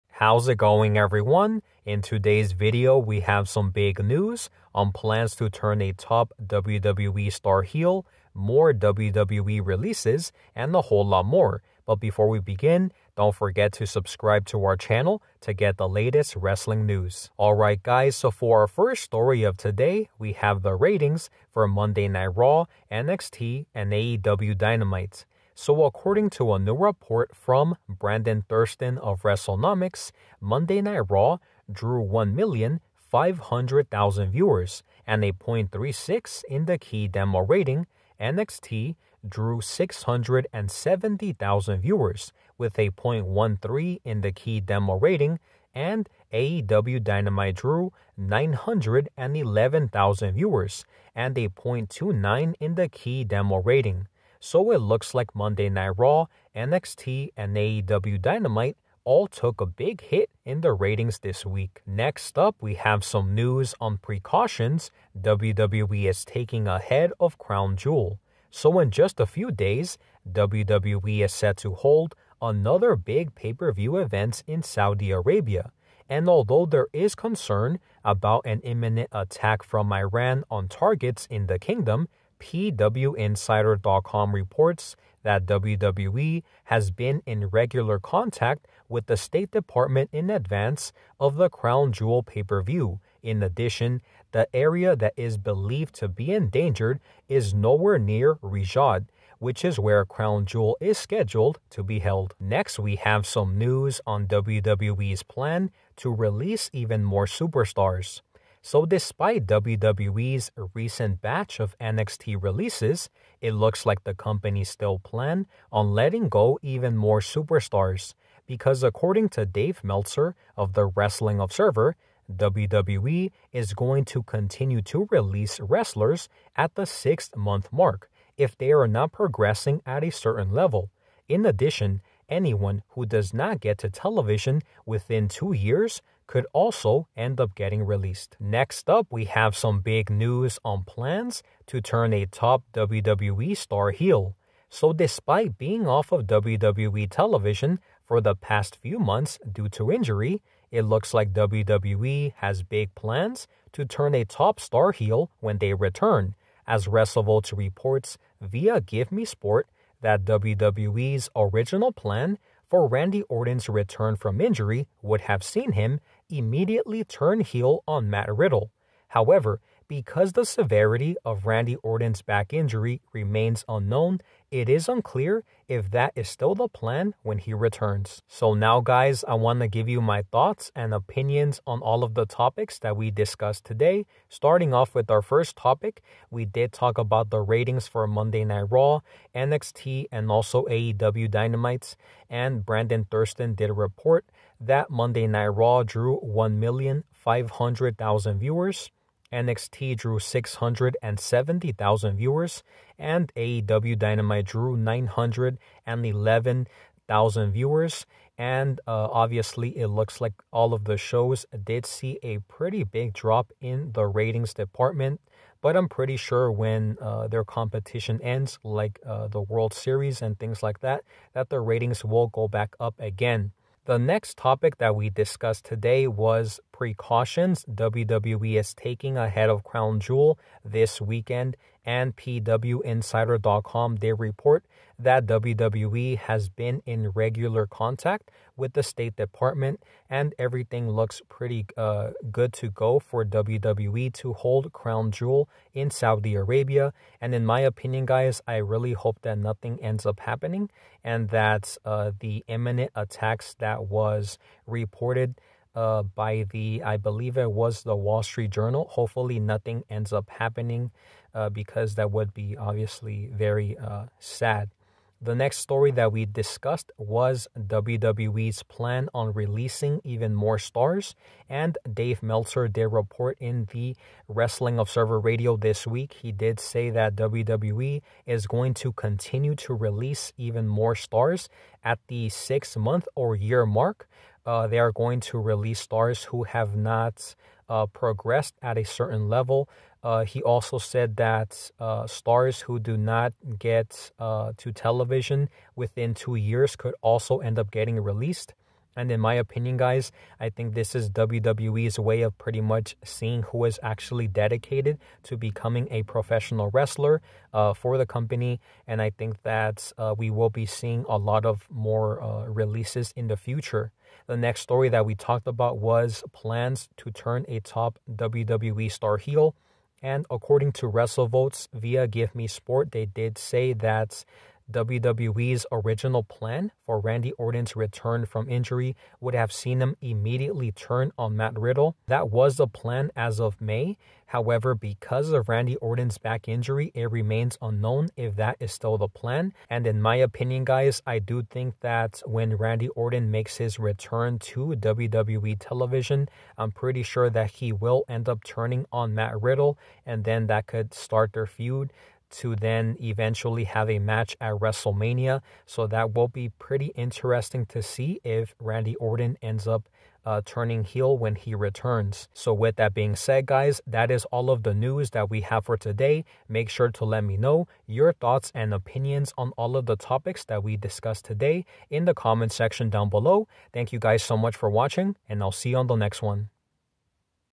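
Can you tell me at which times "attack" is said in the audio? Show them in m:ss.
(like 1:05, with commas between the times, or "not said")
1:19, 4:12.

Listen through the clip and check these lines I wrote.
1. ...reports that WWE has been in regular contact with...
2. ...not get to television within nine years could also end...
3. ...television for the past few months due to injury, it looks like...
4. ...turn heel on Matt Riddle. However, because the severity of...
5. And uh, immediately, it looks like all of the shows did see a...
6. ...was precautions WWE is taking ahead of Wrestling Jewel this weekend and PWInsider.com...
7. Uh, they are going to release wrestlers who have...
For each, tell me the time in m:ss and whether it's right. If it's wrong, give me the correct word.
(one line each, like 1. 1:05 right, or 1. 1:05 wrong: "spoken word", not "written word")
1. 1:24 right
2. 2:13 wrong: "two", not "nine"
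3. 2:27 right
4. 2:47 right
5. 3:28 wrong: "obviously", not "immediately"
6. 3:46 wrong: "Crown", not "Wrestling"
7. 4:44 wrong: "stars", not "wrestlers".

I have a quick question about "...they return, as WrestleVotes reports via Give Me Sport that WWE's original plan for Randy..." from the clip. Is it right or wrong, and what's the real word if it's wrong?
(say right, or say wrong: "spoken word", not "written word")
right.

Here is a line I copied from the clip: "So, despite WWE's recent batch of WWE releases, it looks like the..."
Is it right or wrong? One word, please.
wrong.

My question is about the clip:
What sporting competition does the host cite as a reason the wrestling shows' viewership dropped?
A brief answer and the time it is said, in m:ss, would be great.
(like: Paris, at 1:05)
World Series, at 3:39.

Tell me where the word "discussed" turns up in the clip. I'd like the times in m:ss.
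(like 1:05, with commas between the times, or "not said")
3:03, 3:45, 4:26, 6:10.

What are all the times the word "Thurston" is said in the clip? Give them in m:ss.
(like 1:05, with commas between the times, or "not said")
0:28, 3:13.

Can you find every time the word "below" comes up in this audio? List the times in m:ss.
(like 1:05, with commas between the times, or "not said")
6:13.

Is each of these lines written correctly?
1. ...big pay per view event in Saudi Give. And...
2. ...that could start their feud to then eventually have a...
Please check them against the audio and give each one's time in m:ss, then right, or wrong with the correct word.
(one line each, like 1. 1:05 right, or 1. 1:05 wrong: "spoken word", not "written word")
1. 1:12 wrong: "Arabia", not "Give"
2. 5:50 right.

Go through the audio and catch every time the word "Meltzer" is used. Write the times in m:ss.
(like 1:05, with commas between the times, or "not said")
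1:59, 4:32.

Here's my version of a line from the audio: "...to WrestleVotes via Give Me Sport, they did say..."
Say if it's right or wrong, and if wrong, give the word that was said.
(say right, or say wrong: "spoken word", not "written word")
right.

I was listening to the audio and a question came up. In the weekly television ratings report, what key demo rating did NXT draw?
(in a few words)
0.13.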